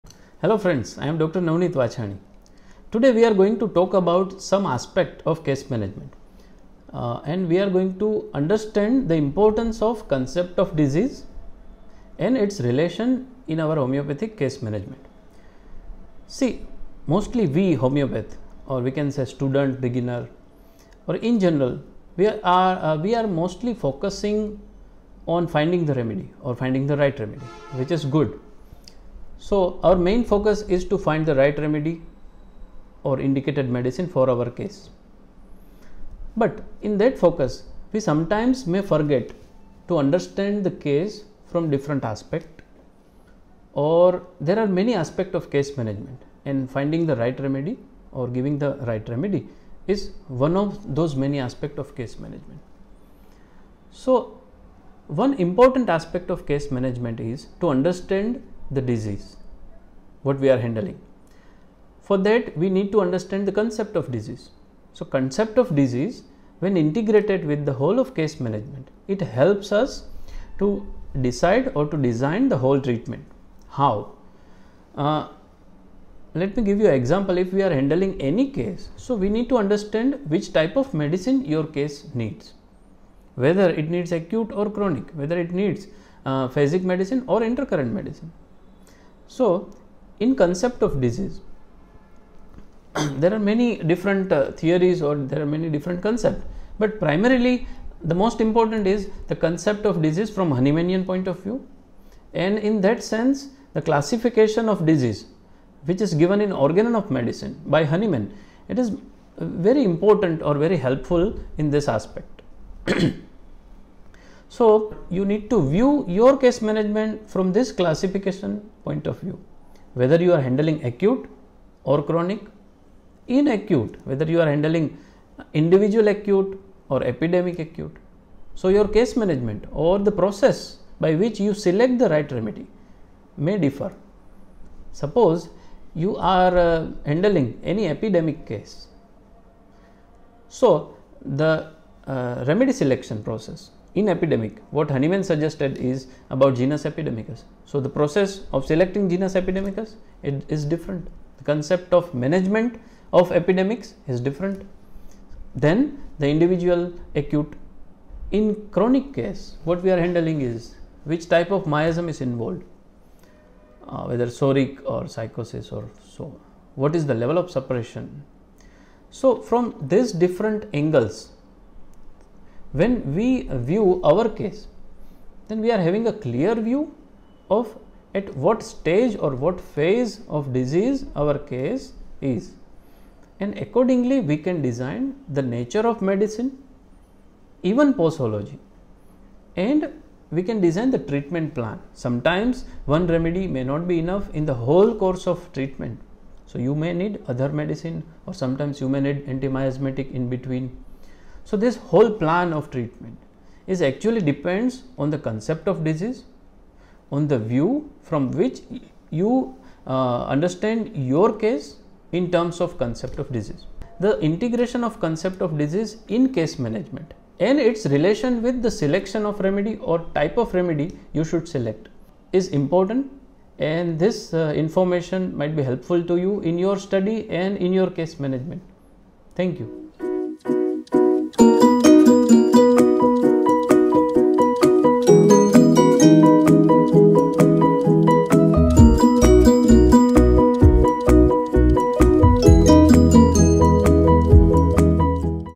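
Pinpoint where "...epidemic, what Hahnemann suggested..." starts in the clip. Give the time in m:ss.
2:24.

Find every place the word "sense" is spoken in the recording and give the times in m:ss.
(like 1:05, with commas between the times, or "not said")
1:43.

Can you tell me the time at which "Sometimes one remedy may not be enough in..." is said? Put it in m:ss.
3:11.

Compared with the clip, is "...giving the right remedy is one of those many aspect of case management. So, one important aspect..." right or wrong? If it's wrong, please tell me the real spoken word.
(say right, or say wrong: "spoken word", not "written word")
right.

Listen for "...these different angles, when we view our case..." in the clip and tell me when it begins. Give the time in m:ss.
2:49.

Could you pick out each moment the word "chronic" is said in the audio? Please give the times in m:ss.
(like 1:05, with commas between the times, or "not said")
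1:24, 2:02, 2:38.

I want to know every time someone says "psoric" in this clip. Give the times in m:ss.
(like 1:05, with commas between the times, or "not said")
2:44.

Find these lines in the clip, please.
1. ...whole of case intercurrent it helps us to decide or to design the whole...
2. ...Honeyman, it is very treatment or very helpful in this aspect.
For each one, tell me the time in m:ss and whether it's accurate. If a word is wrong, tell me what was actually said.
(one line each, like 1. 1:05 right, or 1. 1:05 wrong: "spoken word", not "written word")
1. 1:07 wrong: "management", not "intercurrent"
2. 1:47 wrong: "important", not "treatment".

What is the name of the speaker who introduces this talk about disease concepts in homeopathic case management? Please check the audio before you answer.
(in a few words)
Dr. Navnit Vachhani.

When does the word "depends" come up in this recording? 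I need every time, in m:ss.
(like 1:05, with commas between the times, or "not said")
3:24.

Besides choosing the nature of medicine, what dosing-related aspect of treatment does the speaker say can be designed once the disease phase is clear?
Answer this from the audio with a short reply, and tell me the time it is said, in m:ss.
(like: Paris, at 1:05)
Posology, at 3:07.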